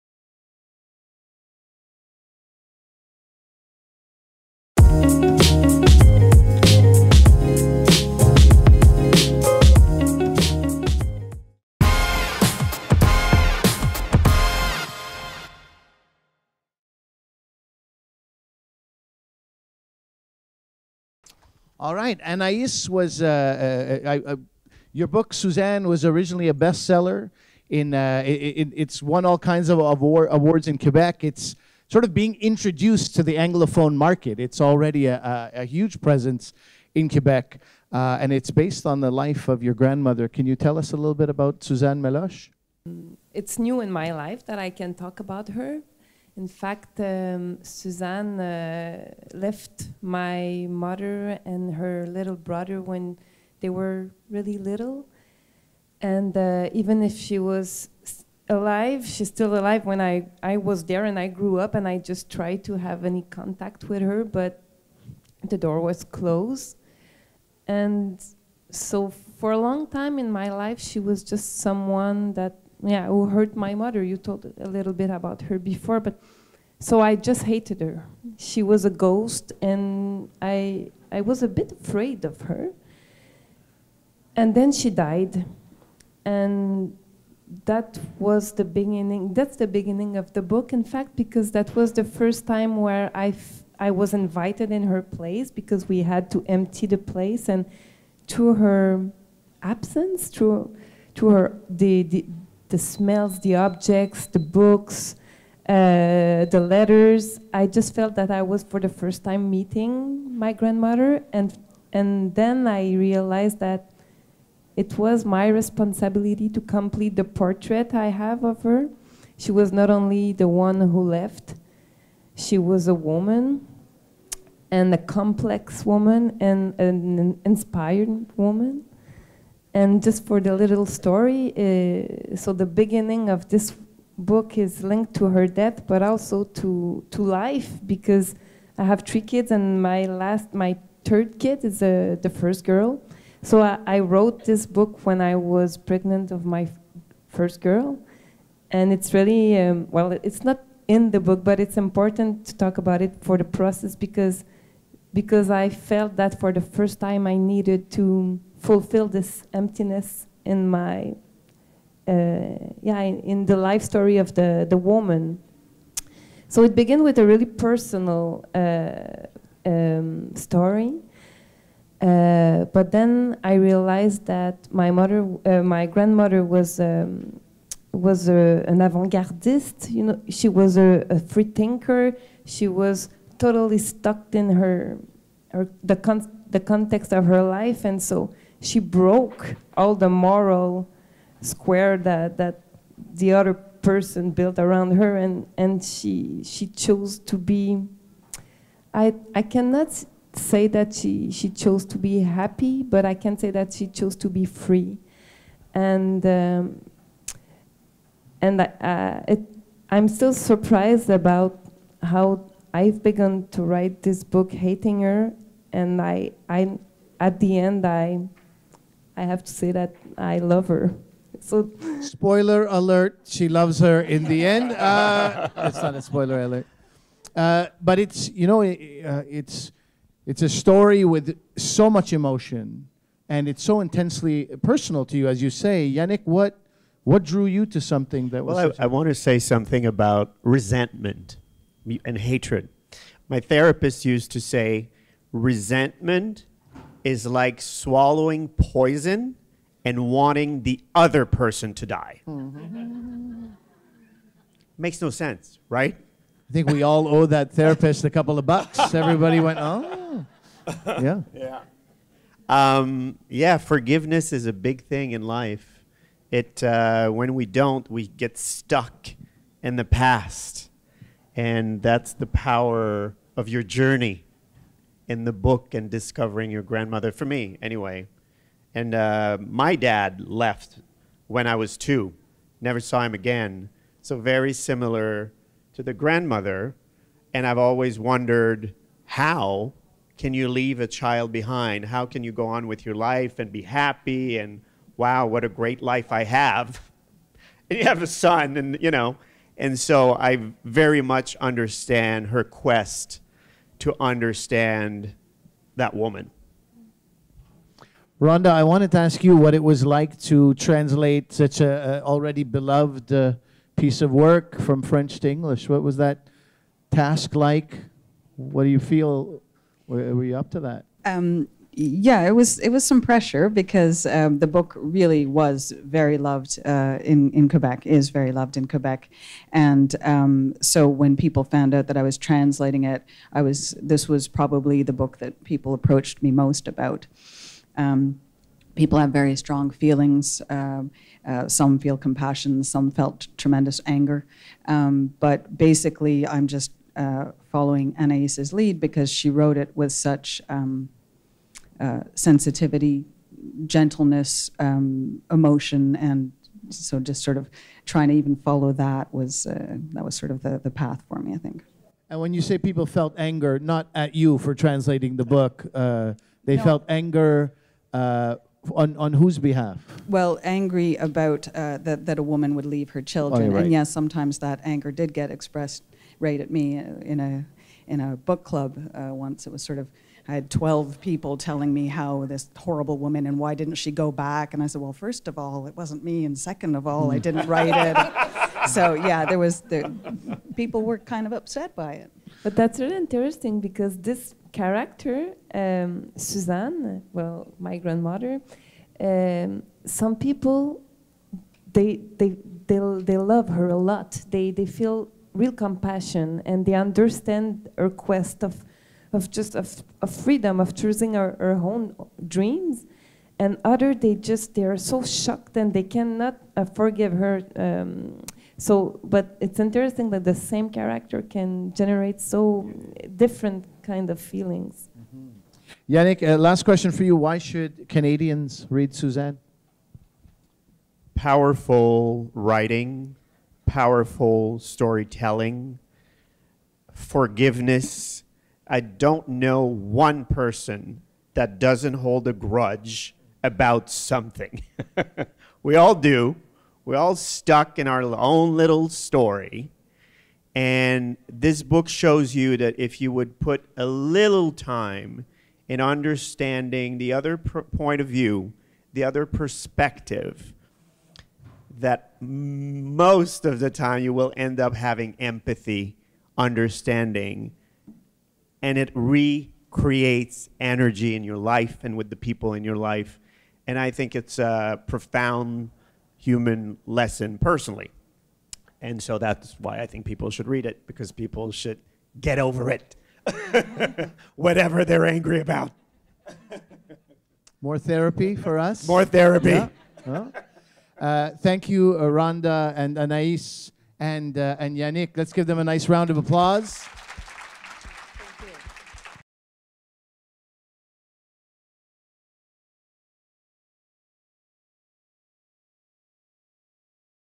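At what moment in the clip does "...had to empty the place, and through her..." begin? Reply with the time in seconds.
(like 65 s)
96 s.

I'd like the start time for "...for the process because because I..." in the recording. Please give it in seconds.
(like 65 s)
153 s.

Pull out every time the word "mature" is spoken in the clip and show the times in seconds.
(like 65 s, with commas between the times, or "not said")
not said.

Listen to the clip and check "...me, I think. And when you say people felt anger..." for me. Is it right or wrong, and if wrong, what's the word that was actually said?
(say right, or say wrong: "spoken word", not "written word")
right.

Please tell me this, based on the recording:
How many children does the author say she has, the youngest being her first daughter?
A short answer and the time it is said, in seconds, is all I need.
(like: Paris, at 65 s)
3, at 139 s.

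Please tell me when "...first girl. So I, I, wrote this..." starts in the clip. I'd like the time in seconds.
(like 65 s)
142 s.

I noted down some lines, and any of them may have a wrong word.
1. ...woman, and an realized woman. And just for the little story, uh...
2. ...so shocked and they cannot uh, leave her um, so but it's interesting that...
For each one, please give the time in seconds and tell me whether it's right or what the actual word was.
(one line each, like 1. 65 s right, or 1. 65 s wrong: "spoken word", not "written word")
1. 125 s wrong: "inspired", not "realized"
2. 414 s wrong: "forgive", not "leave".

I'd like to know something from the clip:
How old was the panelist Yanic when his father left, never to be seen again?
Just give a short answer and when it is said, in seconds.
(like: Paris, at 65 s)
2, at 281 s.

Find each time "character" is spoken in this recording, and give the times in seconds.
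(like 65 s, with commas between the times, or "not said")
394 s, 420 s.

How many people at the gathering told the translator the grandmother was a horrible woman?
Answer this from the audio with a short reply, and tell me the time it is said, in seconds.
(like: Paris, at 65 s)
12, at 380 s.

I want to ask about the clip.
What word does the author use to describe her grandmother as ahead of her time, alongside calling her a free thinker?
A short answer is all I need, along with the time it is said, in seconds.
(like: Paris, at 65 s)
avant-gardist, at 178 s.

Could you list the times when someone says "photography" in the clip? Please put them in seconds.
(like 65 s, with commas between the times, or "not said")
not said.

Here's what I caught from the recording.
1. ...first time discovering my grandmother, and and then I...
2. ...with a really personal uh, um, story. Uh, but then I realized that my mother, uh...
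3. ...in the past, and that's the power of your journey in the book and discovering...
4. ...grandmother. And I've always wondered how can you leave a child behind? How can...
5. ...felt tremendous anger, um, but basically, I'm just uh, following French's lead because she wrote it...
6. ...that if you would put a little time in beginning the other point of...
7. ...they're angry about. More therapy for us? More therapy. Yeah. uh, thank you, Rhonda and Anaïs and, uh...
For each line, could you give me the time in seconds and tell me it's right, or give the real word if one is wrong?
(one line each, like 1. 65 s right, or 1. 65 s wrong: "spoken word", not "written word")
1. 108 s wrong: "meeting", not "discovering"
2. 167 s right
3. 269 s right
4. 285 s right
5. 342 s wrong: "Anaïs", not "French"
6. 452 s wrong: "understanding", not "beginning"
7. 484 s right.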